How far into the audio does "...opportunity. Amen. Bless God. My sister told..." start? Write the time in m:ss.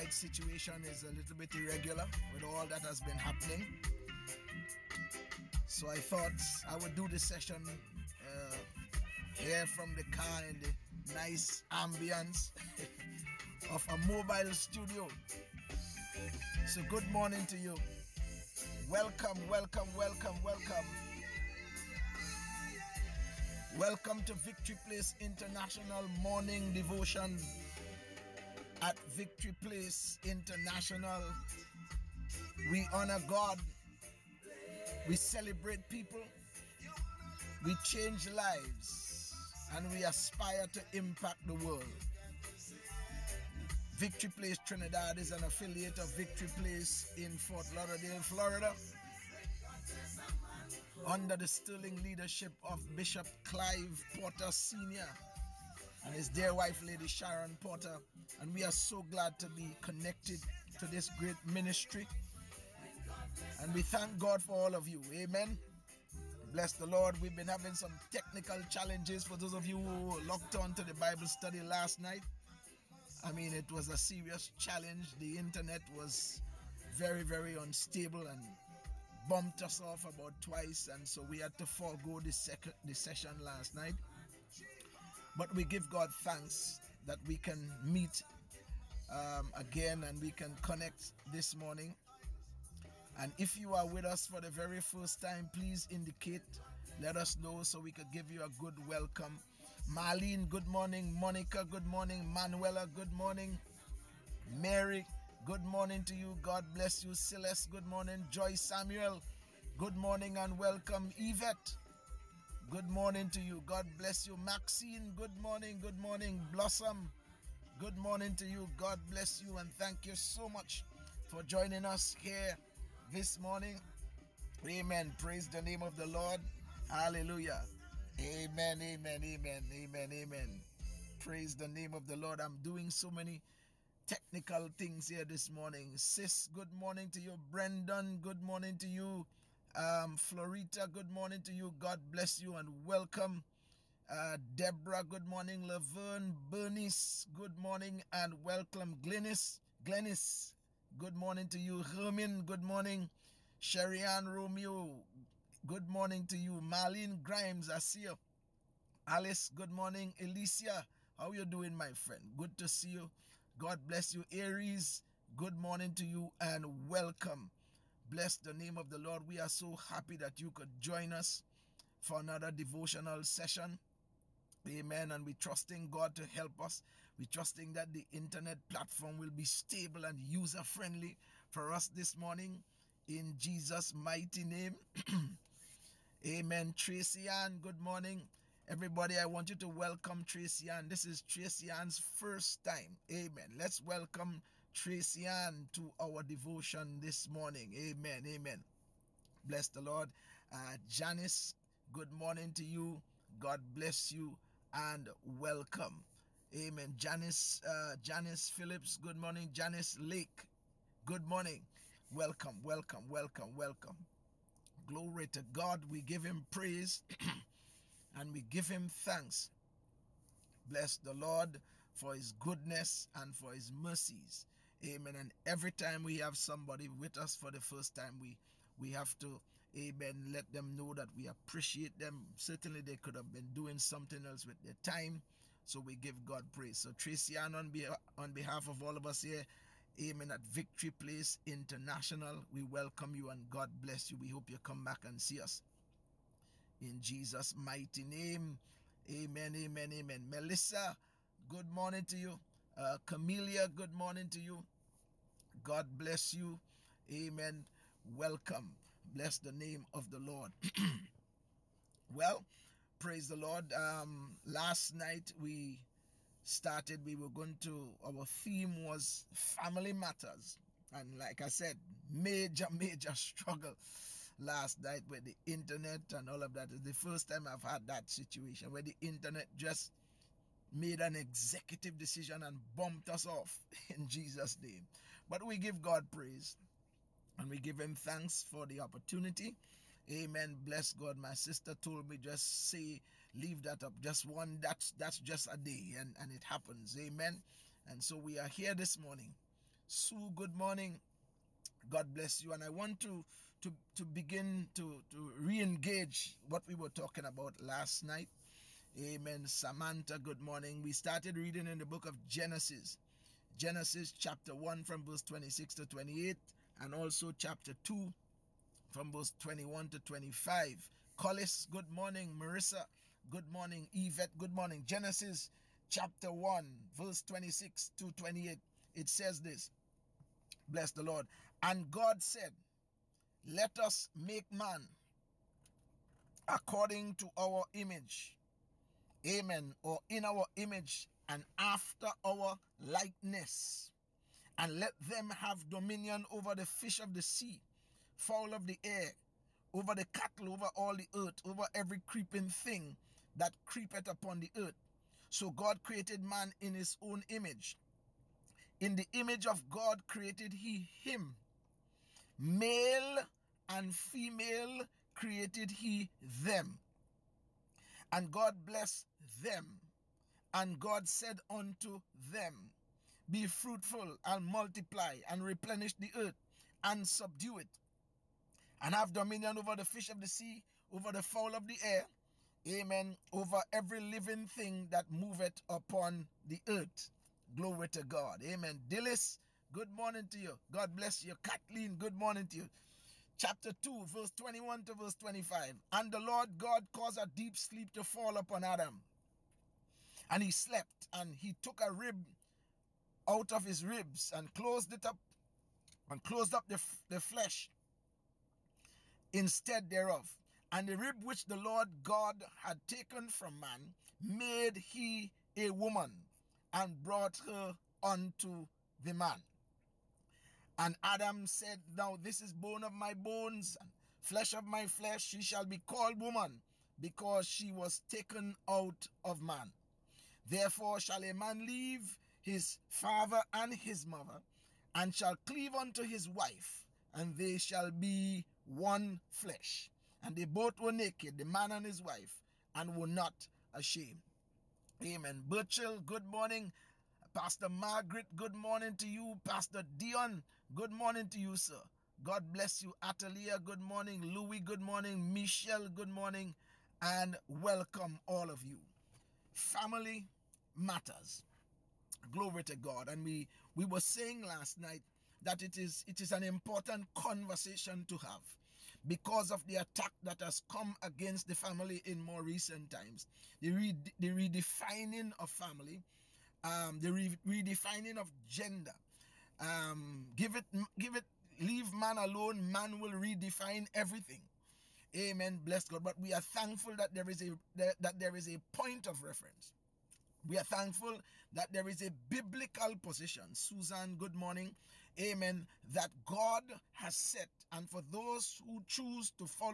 4:48.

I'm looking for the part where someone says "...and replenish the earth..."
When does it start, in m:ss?
6:15.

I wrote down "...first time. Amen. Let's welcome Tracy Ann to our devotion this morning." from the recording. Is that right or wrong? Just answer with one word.
right.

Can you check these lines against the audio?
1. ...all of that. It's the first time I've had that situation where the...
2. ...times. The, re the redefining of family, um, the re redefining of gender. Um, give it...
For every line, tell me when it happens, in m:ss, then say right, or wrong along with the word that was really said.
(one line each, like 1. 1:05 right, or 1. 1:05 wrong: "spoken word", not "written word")
1. 4:36 right
2. 7:52 right.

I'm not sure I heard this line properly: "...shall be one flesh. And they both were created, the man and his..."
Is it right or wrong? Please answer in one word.
wrong.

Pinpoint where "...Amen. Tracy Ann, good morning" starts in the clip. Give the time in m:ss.
3:06.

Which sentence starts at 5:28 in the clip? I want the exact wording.
It says this Bless the Lord.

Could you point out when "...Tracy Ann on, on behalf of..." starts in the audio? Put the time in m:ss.
3:56.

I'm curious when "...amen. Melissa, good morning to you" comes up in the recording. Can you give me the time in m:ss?
4:09.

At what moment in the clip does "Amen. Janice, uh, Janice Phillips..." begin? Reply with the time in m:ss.
3:26.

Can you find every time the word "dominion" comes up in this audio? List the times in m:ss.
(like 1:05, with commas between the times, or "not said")
5:45, 6:19.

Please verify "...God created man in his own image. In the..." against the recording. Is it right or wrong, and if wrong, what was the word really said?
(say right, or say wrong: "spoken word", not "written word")
right.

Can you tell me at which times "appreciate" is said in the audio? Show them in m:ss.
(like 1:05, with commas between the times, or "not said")
3:51.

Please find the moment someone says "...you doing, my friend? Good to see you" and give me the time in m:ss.
2:41.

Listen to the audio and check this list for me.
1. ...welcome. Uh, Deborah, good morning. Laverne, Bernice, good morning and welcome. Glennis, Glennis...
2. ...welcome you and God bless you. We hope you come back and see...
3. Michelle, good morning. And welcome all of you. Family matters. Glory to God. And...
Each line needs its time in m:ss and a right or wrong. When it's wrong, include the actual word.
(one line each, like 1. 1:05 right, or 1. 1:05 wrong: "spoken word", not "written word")
1. 2:22 right
2. 4:02 right
3. 7:35 right.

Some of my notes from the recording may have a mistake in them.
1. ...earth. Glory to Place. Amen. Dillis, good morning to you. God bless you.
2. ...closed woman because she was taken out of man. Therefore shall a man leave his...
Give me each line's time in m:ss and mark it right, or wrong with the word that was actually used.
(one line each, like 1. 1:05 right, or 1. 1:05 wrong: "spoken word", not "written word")
1. 6:26 wrong: "God", not "Place"
2. 7:05 wrong: "called", not "closed".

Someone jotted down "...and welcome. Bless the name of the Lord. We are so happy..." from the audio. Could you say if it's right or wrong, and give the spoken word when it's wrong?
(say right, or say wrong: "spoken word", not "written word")
right.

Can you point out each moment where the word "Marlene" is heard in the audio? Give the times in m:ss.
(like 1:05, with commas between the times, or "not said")
1:39, 2:36.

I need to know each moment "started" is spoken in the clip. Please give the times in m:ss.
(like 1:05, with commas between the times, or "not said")
4:26, 5:10.